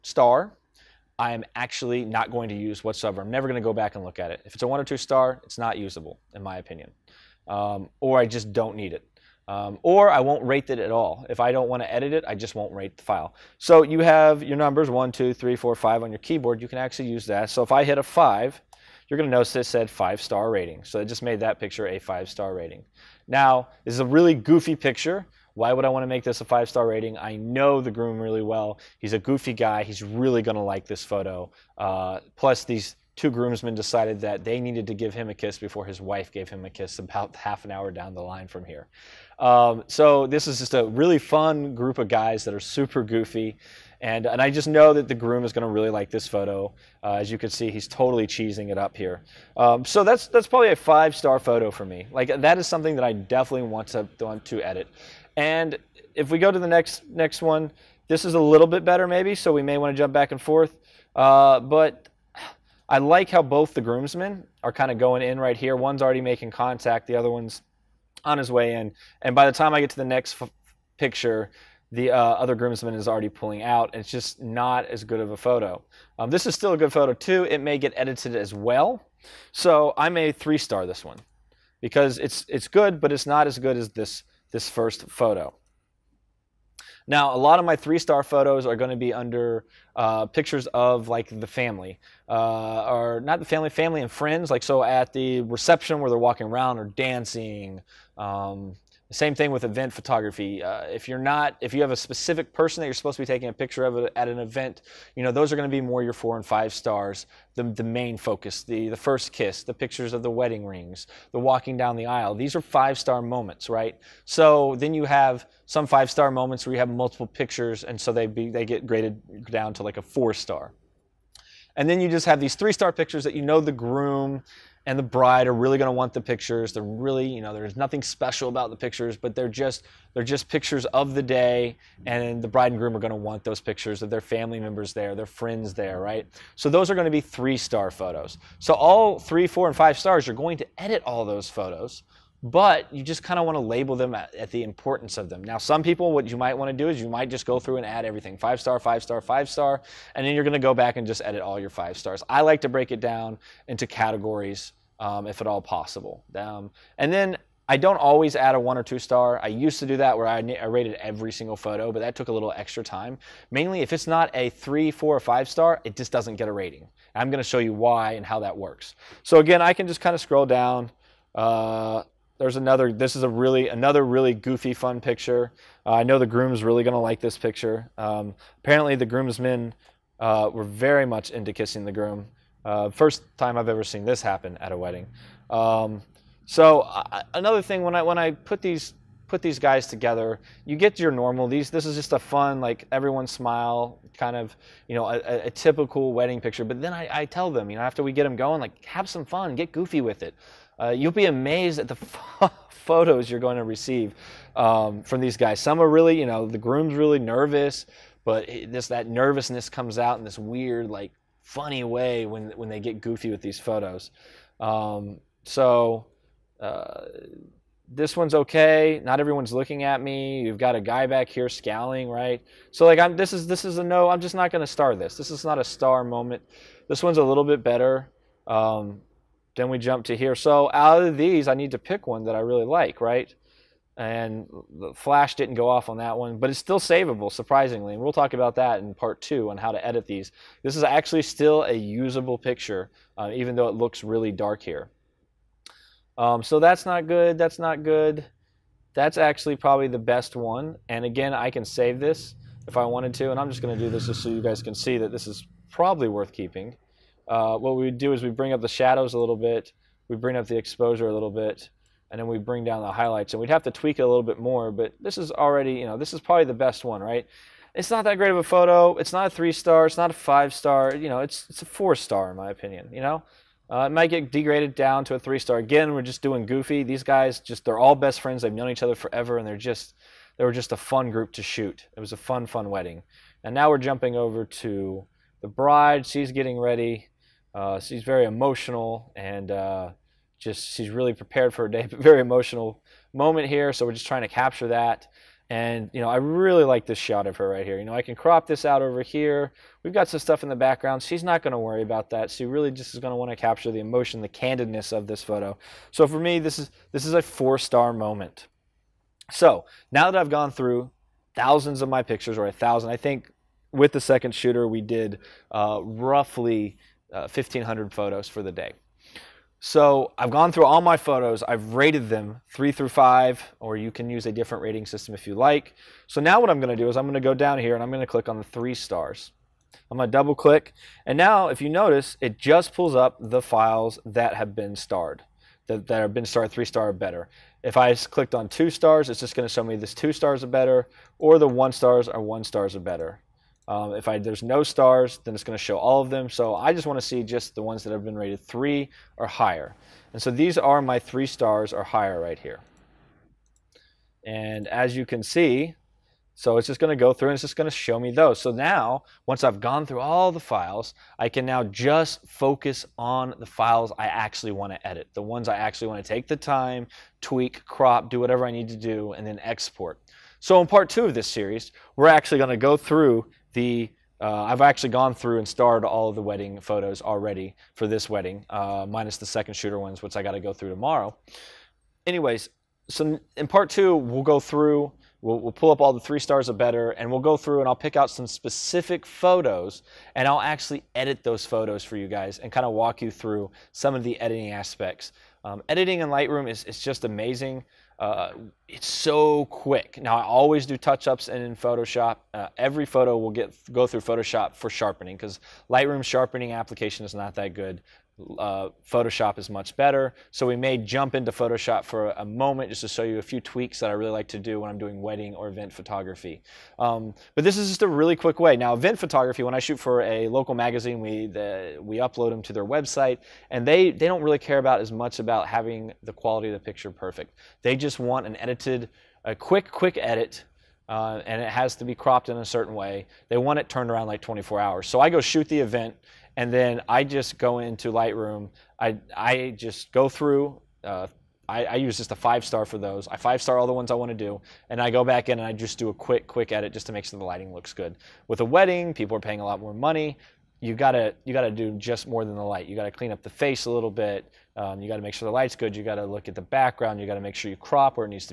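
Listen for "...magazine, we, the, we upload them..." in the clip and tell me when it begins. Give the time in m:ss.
7:00.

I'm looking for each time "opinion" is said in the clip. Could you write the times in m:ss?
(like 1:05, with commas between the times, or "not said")
0:06, 4:32.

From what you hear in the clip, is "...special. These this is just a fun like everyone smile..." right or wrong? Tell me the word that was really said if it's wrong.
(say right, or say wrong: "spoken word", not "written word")
wrong: "normal", not "special".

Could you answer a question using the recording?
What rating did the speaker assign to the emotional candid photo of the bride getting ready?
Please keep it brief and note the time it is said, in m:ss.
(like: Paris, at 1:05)
Four-star, at 5:07.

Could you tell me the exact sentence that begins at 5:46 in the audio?
So I just want to see just the ones that have been rated 3 or higher.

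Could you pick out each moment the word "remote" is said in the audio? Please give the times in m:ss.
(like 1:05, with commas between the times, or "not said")
not said.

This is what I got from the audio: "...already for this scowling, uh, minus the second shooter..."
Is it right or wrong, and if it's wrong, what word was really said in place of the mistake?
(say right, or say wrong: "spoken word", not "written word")
wrong: "wedding", not "scowling".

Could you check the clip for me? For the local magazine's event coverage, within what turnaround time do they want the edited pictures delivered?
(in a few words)
24 hours.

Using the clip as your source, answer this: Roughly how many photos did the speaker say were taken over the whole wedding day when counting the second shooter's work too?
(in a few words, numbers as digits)
1,500.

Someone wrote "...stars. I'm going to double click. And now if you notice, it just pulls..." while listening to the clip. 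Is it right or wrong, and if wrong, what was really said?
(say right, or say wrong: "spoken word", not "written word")
right.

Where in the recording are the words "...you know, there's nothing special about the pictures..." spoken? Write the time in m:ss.
2:07.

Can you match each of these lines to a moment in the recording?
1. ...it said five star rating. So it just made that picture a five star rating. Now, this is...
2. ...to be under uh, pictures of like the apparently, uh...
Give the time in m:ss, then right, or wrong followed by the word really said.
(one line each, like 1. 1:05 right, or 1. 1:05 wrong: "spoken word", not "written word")
1. 0:19 right
2. 1:28 wrong: "family", not "apparently".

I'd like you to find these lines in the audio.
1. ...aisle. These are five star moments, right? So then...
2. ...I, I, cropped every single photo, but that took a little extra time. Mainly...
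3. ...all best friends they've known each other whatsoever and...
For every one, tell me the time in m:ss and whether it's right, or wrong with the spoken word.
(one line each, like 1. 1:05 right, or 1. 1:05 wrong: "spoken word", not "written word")
1. 1:52 right
2. 2:40 wrong: "rated", not "cropped"
3. 4:37 wrong: "forever", not "whatsoever".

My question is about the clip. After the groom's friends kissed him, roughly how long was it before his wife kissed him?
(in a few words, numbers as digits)
Half an hour.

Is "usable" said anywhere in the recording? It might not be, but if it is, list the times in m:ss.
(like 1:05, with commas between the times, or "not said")
0:05, 4:01.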